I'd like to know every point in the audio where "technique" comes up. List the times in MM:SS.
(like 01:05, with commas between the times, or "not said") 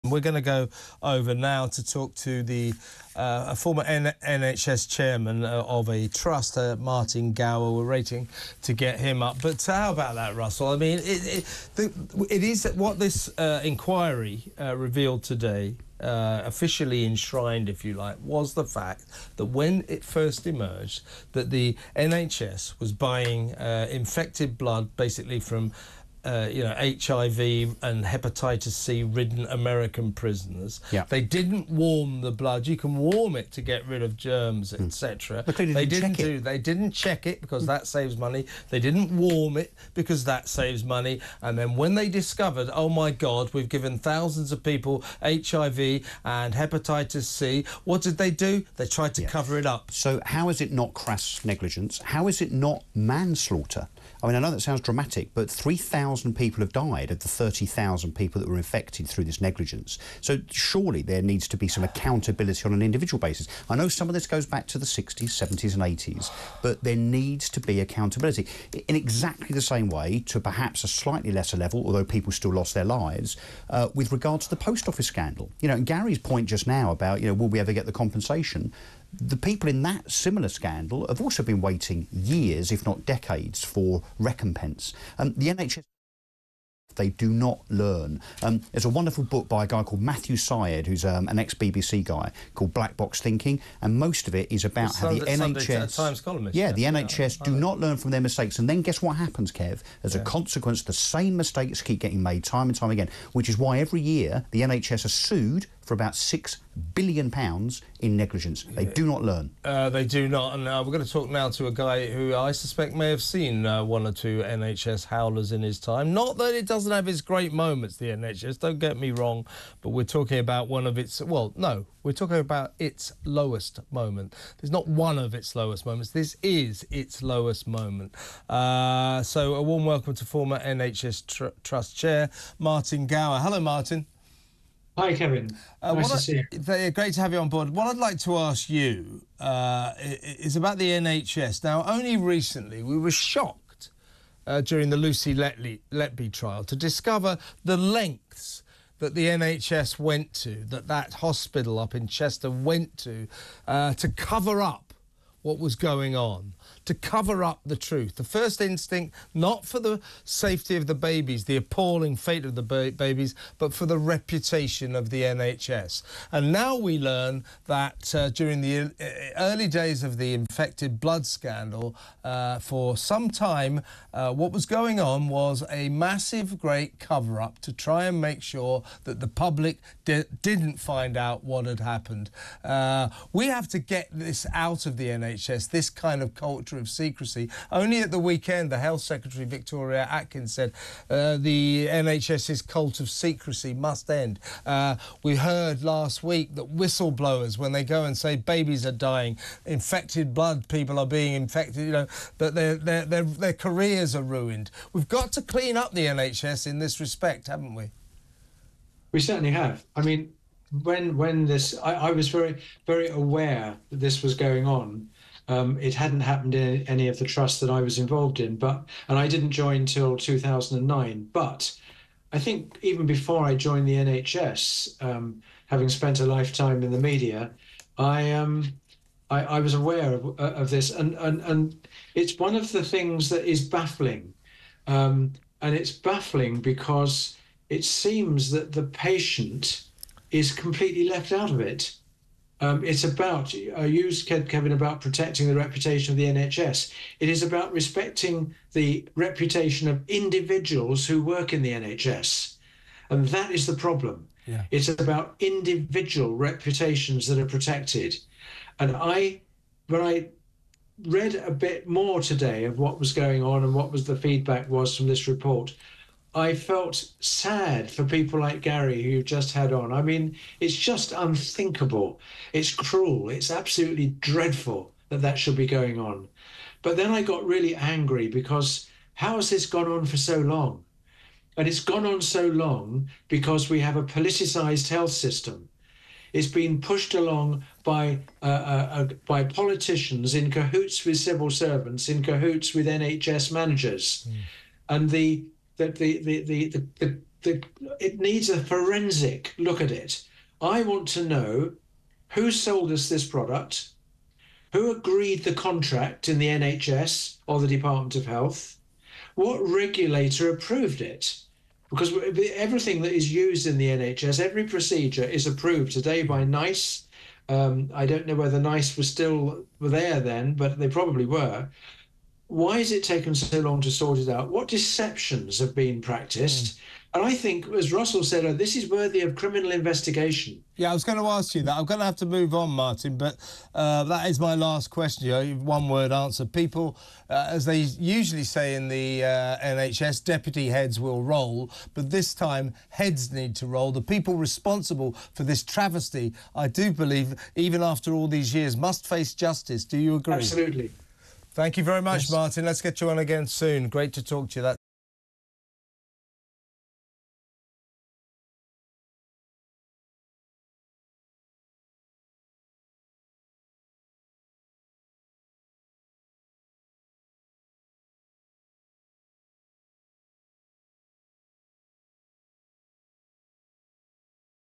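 not said.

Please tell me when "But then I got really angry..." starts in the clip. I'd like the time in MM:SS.
04:36.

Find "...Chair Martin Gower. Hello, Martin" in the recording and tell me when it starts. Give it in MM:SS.
02:11.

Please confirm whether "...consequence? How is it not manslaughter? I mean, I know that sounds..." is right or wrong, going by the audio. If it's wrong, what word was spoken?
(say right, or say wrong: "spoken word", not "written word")
wrong: "negligence", not "consequence".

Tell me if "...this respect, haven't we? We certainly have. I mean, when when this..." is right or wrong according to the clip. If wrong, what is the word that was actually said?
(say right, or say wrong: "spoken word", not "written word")
right.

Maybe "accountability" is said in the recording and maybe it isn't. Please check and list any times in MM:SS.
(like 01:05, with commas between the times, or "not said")
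01:01, 01:07.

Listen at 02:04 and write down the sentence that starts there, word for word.
There's not one of its lowest moments.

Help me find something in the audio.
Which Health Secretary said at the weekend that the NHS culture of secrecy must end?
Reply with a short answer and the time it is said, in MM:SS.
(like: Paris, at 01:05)
Victoria Atkins, at 03:09.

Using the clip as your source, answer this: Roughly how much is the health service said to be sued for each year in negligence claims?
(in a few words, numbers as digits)
£6 billion.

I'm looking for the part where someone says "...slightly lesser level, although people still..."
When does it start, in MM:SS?
01:10.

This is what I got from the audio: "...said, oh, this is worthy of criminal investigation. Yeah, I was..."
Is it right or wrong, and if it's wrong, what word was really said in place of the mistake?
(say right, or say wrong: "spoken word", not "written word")
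right.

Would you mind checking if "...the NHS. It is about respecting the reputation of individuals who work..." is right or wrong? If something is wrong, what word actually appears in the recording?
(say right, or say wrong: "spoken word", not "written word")
right.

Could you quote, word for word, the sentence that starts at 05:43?
The people responsible for this travesty, I do believe, even after all these years, must face justice.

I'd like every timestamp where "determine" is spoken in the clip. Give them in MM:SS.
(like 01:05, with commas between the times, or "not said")
not said.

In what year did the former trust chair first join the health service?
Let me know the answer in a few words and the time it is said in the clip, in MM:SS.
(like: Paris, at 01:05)
2009, at 03:40.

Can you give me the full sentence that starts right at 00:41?
And then when they discovered, oh my God, we've given thousands of people HIV and hepatitis C, what did they do?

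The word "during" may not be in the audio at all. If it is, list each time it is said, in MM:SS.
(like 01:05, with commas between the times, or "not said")
02:24, 02:48.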